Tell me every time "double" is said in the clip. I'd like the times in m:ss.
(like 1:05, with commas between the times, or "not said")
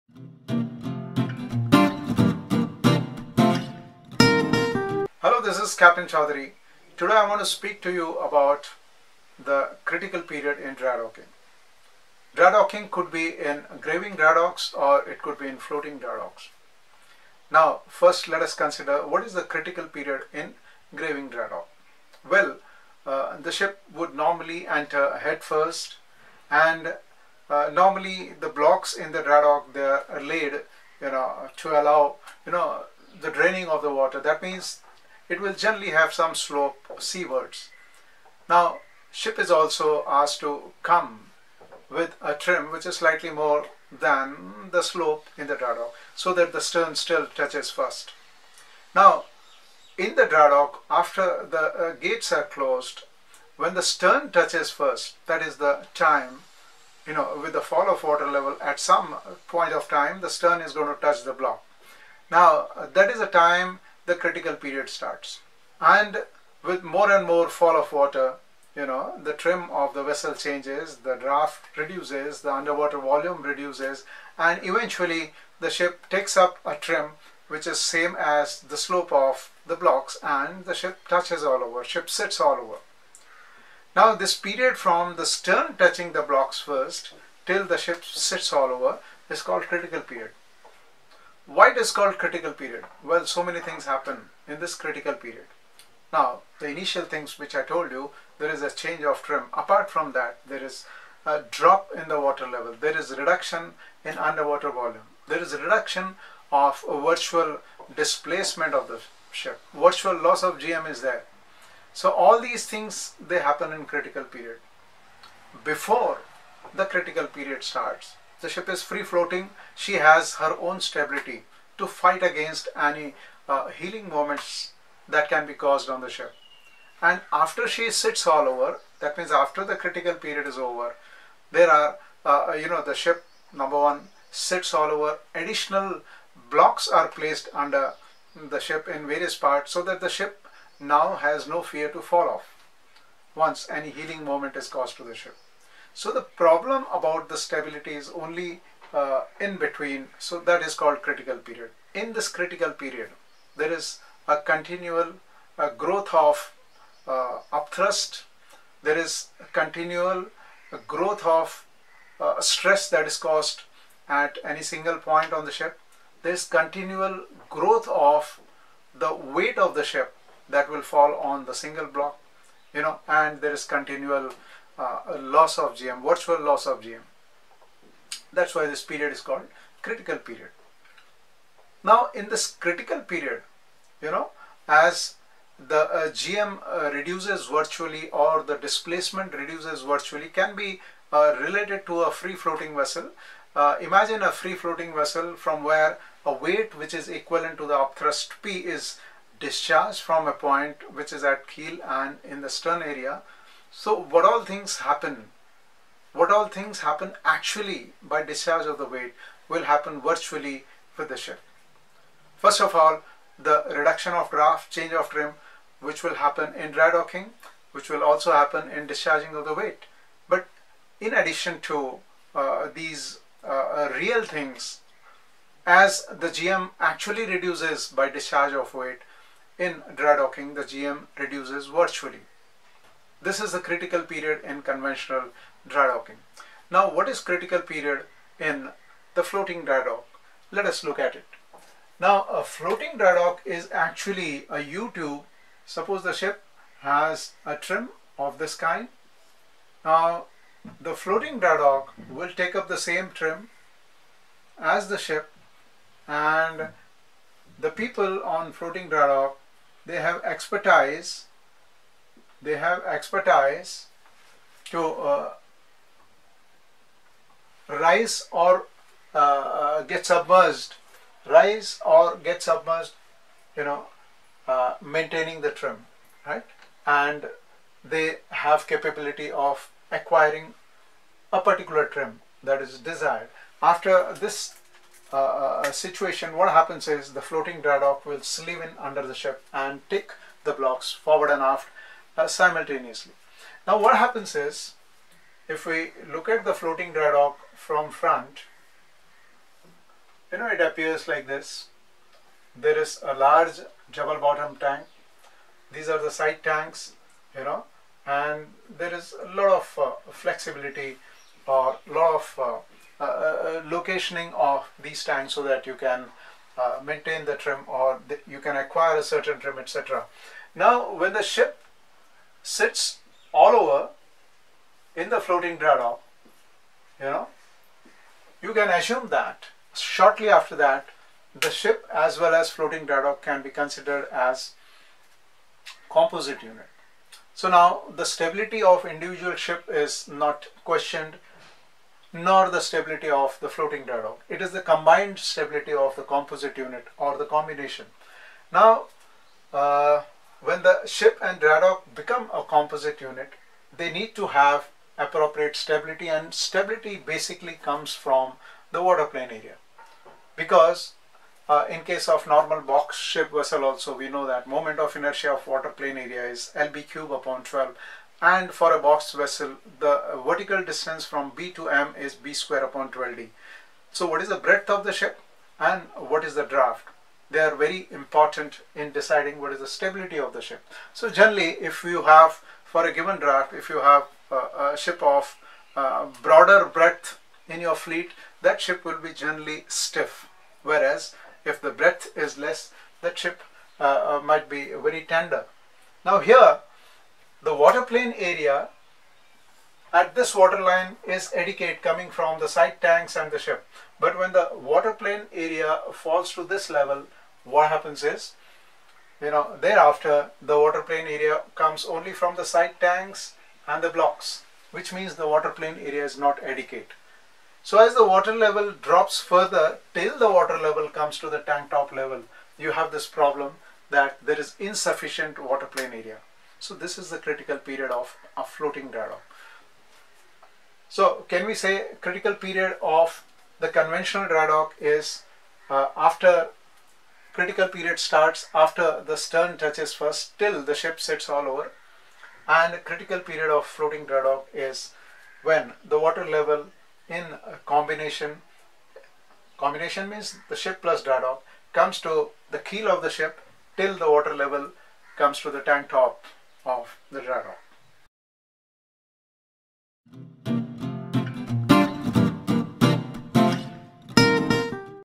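5:03.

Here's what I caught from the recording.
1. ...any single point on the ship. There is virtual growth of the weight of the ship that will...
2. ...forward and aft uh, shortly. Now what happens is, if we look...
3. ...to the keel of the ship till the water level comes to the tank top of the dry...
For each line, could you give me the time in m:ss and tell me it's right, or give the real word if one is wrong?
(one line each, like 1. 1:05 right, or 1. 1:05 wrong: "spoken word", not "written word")
1. 2:44 wrong: "continual", not "virtual"
2. 4:50 wrong: "simultaneously", not "shortly"
3. 7:32 right.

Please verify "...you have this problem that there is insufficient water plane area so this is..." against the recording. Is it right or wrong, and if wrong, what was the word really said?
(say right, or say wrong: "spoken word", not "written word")
right.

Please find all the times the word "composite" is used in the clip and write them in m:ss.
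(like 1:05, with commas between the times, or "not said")
5:35, 5:46, 5:52.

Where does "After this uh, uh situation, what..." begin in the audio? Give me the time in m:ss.
4:43.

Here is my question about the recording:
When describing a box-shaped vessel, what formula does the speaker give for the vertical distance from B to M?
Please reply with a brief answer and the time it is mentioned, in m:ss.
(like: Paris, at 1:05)
B squared over 12D, at 6:12.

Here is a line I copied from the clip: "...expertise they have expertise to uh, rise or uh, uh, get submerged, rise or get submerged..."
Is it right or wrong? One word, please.
right.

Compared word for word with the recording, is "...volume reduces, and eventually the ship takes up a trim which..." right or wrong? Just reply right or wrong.
right.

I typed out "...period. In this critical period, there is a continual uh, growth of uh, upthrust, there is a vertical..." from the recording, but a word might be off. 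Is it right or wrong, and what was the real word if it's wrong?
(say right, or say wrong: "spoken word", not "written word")
wrong: "continual", not "vertical".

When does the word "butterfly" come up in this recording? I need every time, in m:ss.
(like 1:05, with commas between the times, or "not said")
not said.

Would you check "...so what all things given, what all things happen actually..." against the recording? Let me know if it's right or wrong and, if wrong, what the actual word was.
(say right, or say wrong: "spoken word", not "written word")
wrong: "happen", not "given".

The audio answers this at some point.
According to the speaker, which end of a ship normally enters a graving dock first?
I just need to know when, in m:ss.
0:25.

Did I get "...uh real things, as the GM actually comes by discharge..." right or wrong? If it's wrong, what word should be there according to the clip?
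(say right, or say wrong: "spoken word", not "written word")
wrong: "reduces", not "comes".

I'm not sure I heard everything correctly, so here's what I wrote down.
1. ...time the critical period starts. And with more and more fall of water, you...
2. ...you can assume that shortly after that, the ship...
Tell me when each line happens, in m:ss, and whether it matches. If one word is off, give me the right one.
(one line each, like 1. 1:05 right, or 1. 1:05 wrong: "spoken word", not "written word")
1. 1:03 right
2. 5:28 right.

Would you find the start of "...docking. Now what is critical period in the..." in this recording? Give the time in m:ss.
3:55.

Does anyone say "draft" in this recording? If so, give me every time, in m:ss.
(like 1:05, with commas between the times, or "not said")
1:11, 3:34, 6:16, 6:23.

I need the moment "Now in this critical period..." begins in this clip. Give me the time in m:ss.
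3:01.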